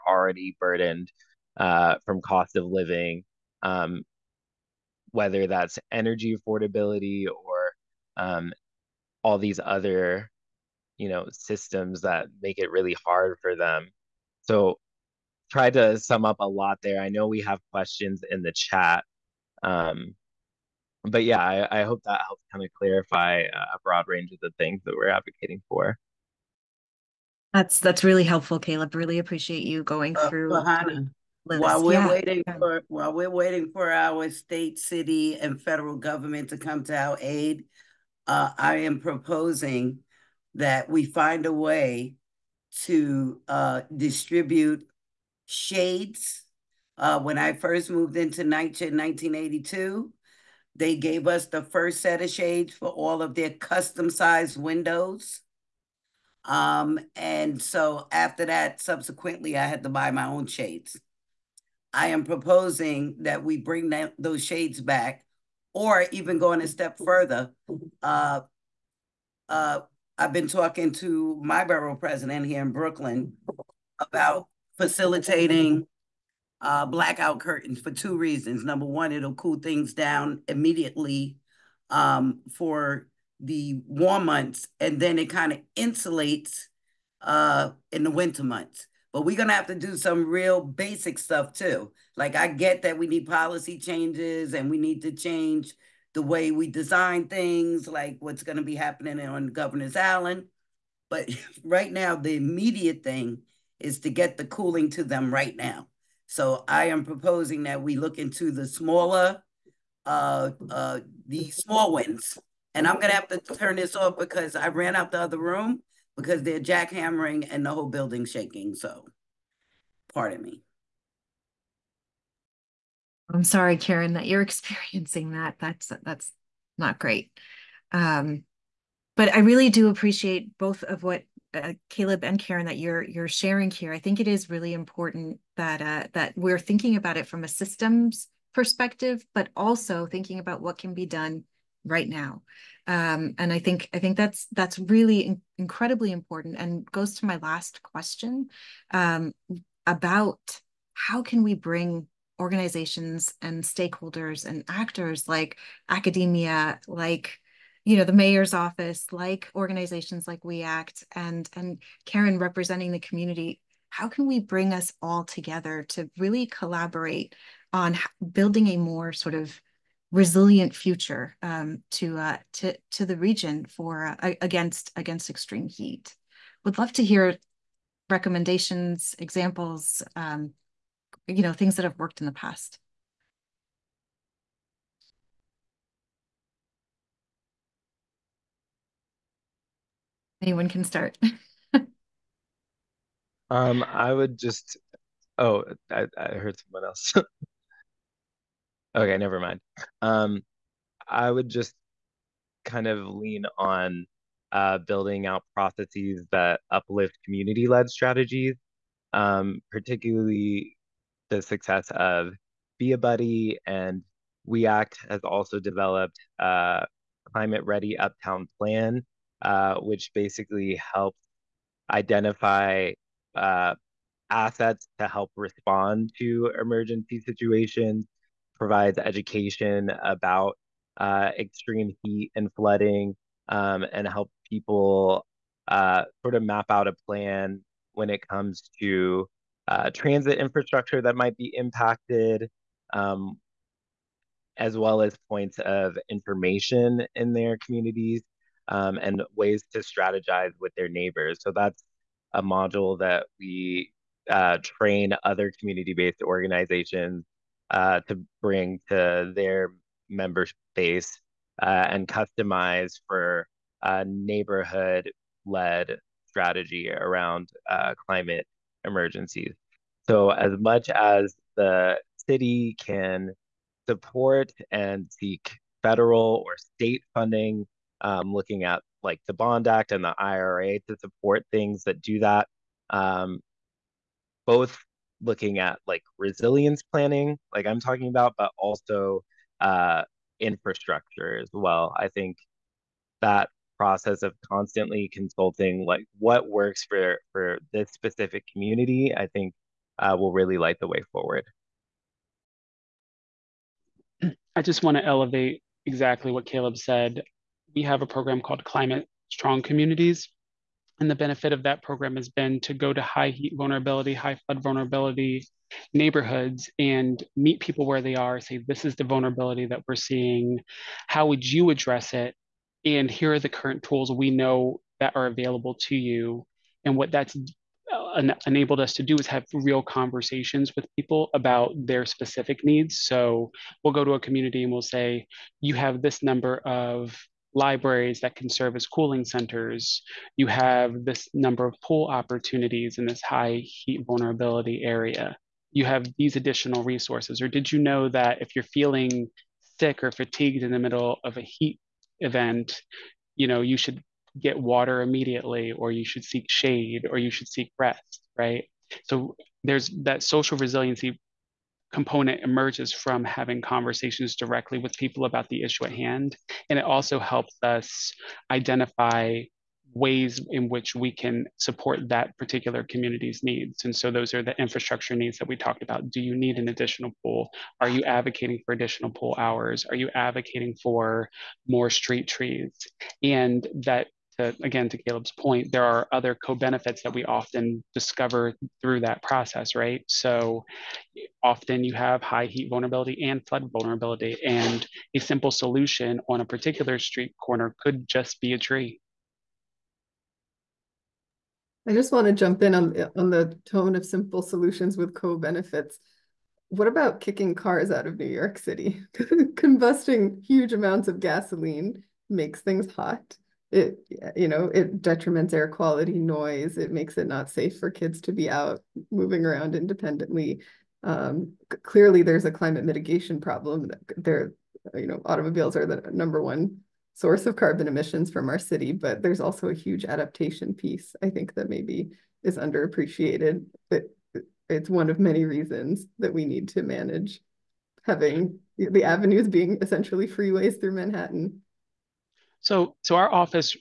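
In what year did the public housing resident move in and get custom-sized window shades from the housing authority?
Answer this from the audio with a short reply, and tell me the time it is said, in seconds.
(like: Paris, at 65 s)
1982, at 48 s.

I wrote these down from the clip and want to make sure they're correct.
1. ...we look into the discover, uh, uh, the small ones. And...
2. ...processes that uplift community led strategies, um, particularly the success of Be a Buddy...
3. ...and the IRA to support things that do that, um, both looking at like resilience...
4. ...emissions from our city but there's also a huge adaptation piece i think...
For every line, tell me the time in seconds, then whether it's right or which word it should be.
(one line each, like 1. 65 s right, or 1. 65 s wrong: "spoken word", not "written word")
1. 107 s wrong: "smaller", not "discover"
2. 205 s right
3. 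279 s right
4. 427 s right.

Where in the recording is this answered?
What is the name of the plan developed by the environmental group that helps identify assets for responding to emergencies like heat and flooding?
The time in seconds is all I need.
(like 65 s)
217 s.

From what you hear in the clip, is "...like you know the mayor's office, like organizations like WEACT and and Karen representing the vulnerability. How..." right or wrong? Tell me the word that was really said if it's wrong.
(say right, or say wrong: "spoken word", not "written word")
wrong: "community", not "vulnerability".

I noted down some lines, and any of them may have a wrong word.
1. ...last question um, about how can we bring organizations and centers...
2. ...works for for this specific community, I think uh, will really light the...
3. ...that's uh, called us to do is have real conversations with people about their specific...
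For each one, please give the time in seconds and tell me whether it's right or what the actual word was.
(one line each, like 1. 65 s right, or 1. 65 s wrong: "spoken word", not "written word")
1. 147 s wrong: "stakeholders", not "centers"
2. 296 s right
3. 327 s wrong: "enabled", not "called".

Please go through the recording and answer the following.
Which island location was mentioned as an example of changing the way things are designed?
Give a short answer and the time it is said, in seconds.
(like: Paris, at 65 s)
Governor's Island, at 99 s.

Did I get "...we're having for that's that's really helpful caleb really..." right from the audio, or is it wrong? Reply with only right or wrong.
wrong.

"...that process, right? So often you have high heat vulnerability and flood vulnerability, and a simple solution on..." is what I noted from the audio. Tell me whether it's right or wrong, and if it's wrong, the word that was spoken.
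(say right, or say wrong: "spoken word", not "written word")
right.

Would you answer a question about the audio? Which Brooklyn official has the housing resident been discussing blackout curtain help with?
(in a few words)
borough president.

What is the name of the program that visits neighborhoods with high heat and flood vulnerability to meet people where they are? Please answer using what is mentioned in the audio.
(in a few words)
Climate Strong Communities.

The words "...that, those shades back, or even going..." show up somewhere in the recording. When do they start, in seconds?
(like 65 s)
63 s.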